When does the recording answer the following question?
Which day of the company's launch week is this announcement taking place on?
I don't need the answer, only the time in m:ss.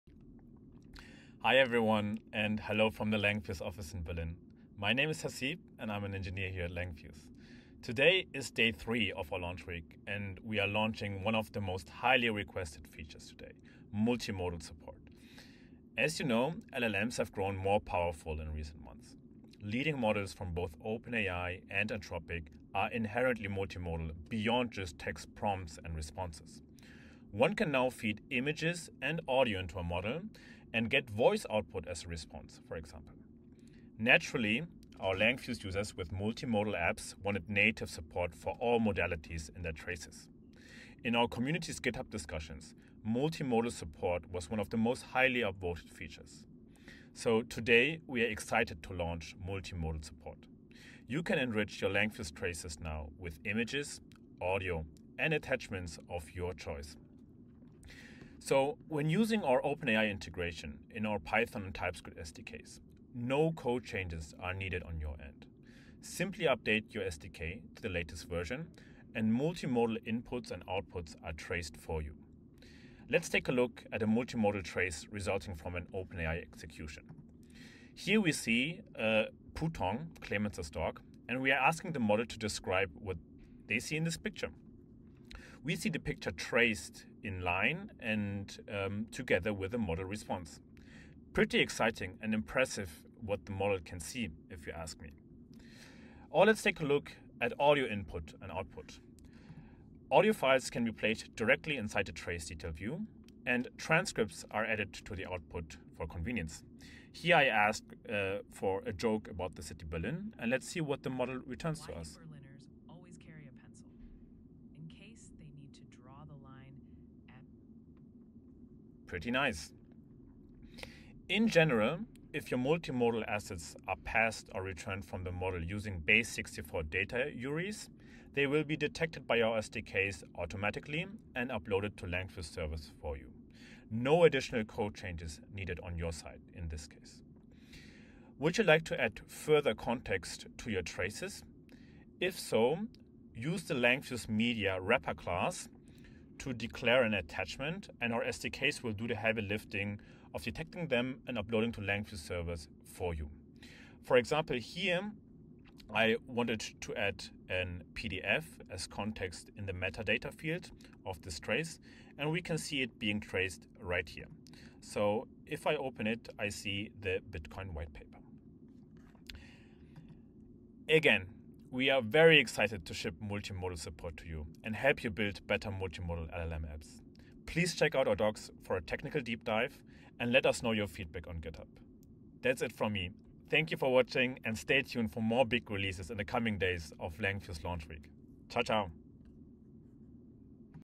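0:08.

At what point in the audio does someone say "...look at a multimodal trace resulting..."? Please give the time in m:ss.
1:13.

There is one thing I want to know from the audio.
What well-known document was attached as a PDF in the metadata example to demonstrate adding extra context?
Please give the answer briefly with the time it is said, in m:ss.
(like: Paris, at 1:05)
Bitcoin white paper, at 2:47.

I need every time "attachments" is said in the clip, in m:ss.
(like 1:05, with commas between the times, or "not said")
0:55, 2:27.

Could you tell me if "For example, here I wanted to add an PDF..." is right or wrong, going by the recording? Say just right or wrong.
right.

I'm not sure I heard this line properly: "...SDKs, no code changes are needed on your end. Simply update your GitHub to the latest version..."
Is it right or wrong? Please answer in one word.
wrong.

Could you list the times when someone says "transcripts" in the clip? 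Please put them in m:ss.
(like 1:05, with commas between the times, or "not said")
1:43.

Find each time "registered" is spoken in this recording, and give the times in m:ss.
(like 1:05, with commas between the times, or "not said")
not said.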